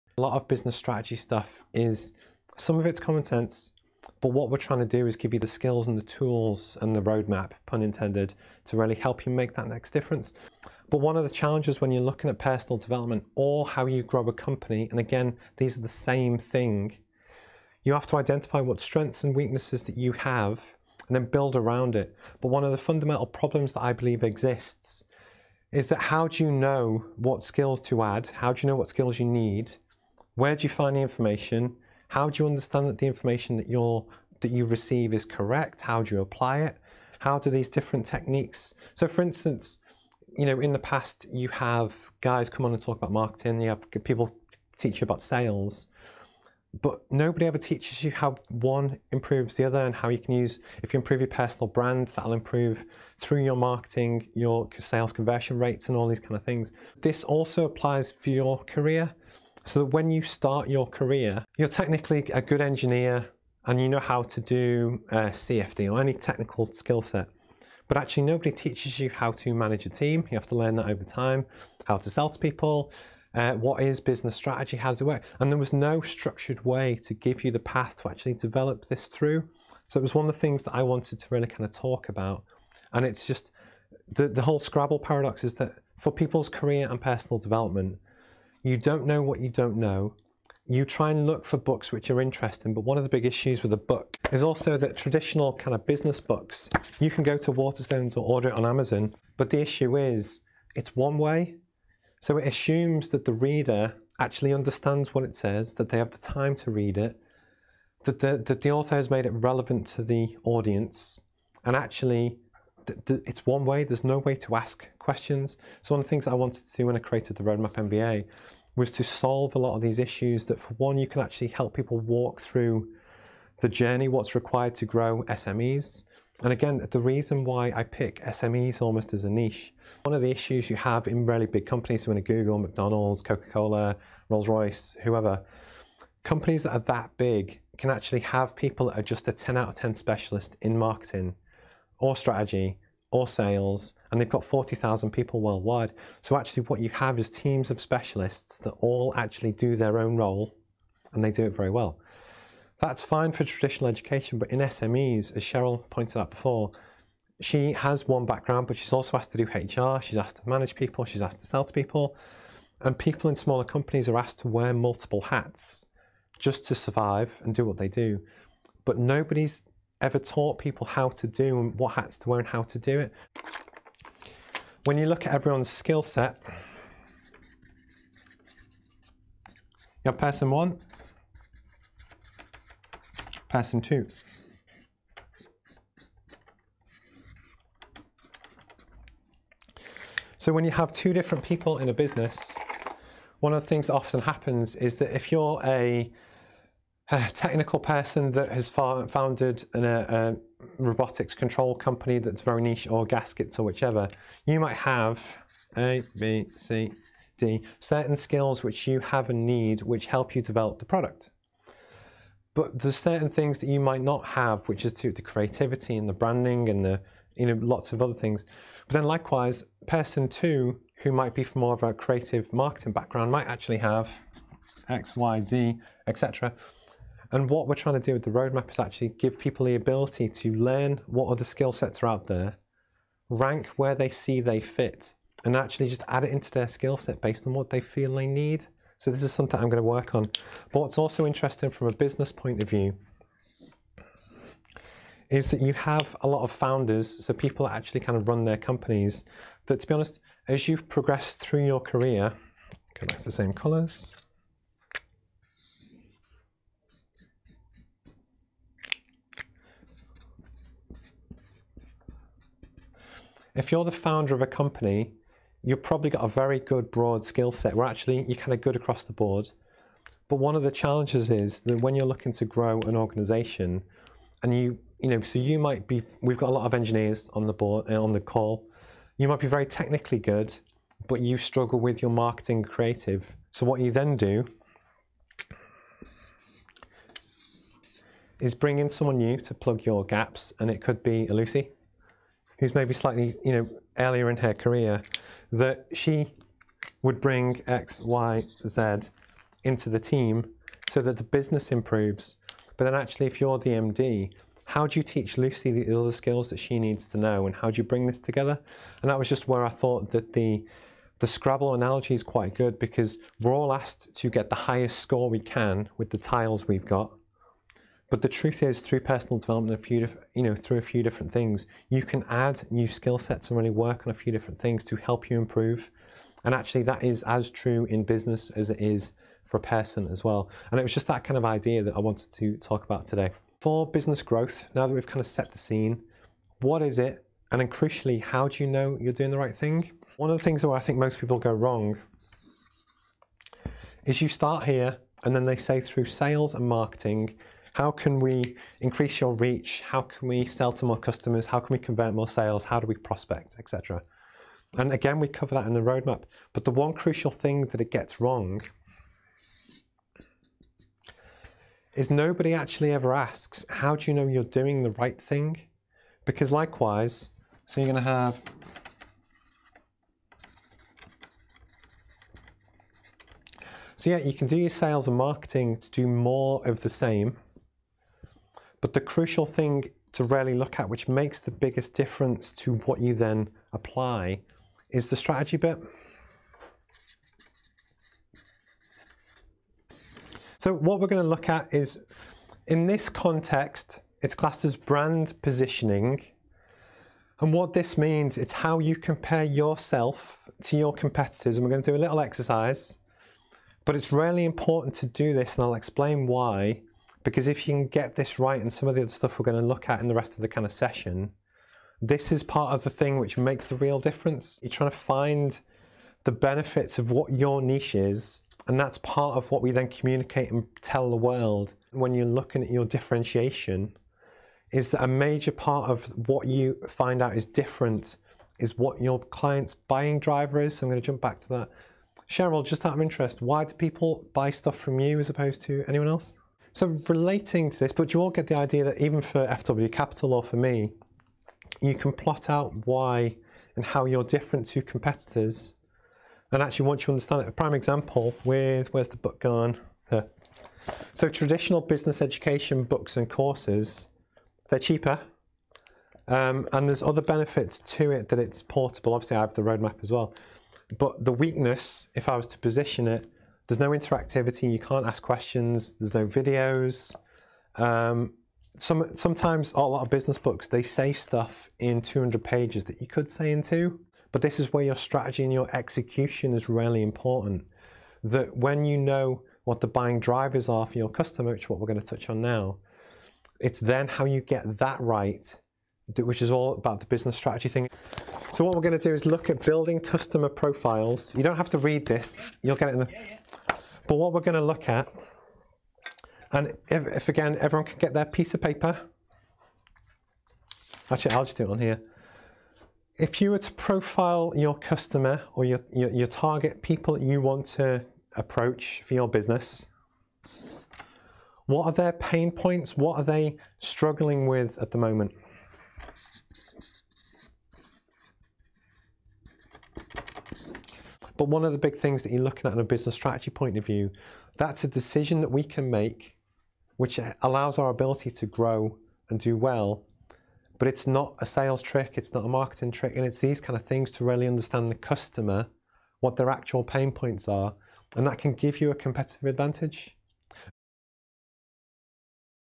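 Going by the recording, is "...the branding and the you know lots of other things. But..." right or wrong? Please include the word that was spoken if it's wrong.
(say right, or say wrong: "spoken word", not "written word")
right.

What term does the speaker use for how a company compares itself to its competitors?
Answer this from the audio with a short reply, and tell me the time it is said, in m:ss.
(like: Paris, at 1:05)
brand positioning, at 6:34.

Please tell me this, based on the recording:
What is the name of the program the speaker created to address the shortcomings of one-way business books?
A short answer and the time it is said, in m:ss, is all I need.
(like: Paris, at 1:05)
Roadmap MBA, at 1:57.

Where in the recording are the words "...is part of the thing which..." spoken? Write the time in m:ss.
6:52.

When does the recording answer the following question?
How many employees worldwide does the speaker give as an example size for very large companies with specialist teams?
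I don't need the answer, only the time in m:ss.
2:24.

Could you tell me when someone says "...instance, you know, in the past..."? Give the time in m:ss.
0:39.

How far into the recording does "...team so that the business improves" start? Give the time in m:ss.
4:59.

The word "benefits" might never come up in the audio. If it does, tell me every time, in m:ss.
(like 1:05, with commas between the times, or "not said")
6:56, 7:37.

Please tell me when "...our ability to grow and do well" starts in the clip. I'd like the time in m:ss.
8:47.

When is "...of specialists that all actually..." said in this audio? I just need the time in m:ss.
2:27.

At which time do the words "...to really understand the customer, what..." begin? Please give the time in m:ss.
8:54.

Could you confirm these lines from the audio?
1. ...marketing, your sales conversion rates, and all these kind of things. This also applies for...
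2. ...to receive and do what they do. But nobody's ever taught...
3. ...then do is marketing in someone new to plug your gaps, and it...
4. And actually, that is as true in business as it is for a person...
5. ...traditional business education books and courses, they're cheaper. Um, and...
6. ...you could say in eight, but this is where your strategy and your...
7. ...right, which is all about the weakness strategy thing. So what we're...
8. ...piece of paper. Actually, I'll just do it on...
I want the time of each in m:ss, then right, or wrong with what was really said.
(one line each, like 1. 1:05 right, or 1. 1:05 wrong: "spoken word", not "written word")
1. 0:53 right
2. 2:46 wrong: "survive", not "receive"
3. 4:43 wrong: "bring", not "marketing"
4. 5:26 right
5. 7:31 right
6. 7:53 wrong: "two", not "eight"
7. 8:04 wrong: "business", not "weakness"
8. 8:18 right.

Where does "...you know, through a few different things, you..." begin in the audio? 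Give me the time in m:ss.
5:20.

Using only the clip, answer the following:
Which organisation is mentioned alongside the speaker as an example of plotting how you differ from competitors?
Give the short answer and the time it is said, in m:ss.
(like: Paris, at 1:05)
FW Capital, at 7:19.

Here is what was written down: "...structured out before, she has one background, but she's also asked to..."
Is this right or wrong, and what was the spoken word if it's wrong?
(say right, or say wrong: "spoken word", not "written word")
wrong: "pointed", not "structured".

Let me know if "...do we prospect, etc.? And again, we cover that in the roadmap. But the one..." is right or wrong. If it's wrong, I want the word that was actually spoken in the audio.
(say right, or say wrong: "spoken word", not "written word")
right.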